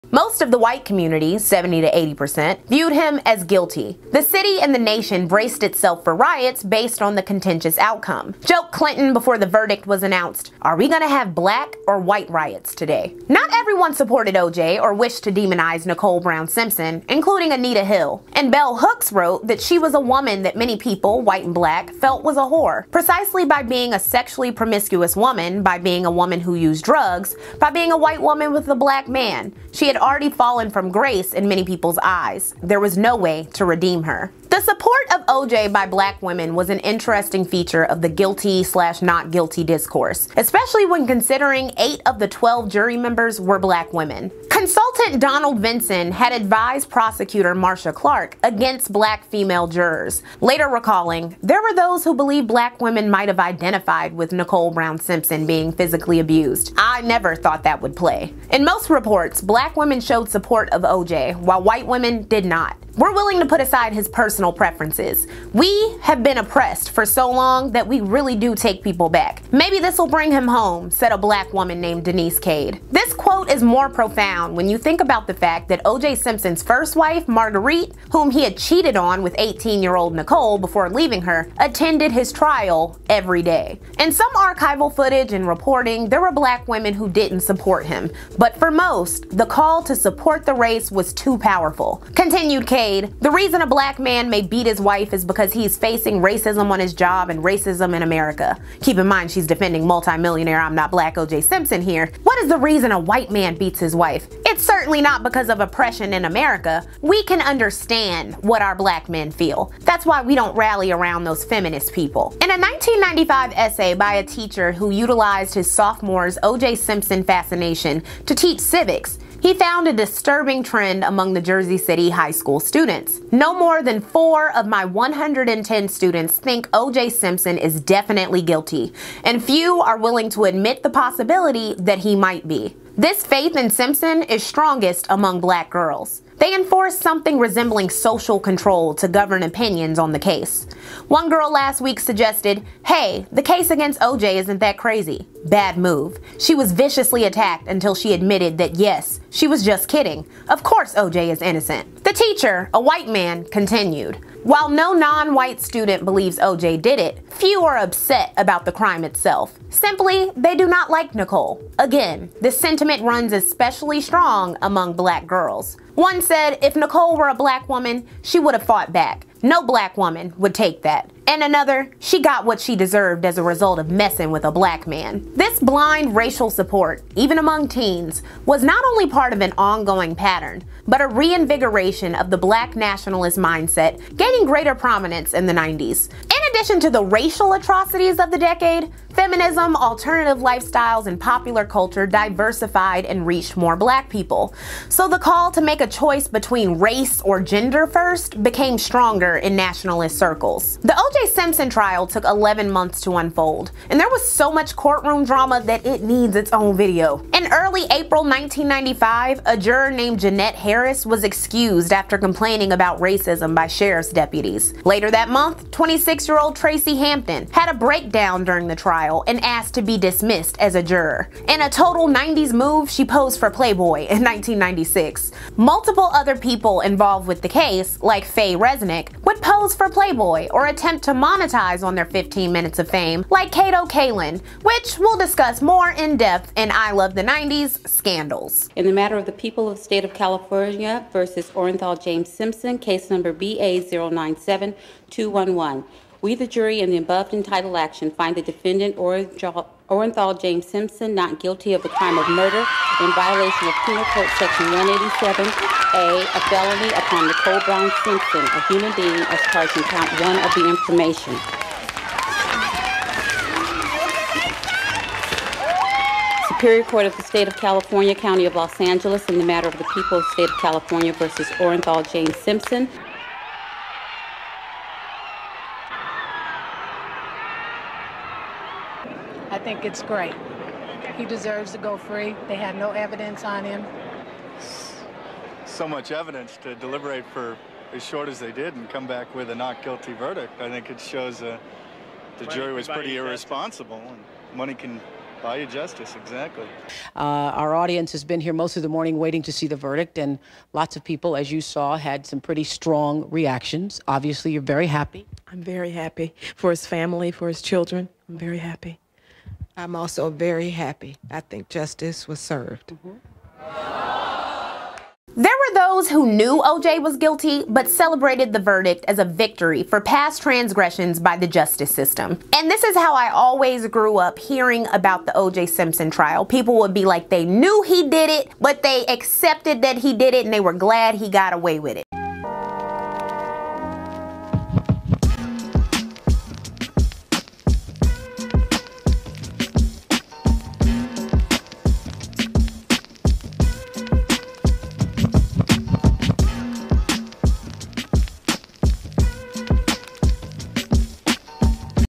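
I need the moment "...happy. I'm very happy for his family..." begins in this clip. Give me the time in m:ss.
5:04.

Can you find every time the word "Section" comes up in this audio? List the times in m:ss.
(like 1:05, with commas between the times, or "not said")
4:14.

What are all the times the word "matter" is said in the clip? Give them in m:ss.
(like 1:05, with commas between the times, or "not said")
3:58, 4:29.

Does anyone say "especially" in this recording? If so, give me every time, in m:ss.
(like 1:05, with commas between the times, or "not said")
0:40, 2:43.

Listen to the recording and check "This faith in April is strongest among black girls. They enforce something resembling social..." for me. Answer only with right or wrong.
wrong.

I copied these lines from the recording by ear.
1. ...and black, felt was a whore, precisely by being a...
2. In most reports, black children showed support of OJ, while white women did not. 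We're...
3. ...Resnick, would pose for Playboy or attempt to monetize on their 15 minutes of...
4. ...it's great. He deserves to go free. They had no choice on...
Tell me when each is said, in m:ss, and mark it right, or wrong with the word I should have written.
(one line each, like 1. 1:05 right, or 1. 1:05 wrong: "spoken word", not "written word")
1. 0:21 right
2. 0:58 wrong: "women", not "children"
3. 3:48 right
4. 4:39 wrong: "evidence", not "choice".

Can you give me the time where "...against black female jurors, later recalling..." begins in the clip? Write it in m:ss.
0:48.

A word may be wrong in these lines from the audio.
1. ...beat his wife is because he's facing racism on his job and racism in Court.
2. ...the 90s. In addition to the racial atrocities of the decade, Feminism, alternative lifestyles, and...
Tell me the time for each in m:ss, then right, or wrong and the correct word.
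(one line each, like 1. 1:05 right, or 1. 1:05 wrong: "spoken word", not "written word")
1. 1:34 wrong: "America", not "Court"
2. 3:05 right.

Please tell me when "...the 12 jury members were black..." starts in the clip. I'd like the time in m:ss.
0:42.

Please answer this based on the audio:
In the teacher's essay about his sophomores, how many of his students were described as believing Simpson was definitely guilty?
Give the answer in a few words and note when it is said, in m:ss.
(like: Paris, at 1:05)
4, at 2:03.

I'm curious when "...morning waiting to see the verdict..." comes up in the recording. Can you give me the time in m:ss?
4:58.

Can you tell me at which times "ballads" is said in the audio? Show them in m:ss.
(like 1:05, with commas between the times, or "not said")
not said.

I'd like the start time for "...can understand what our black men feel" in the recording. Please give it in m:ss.
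1:47.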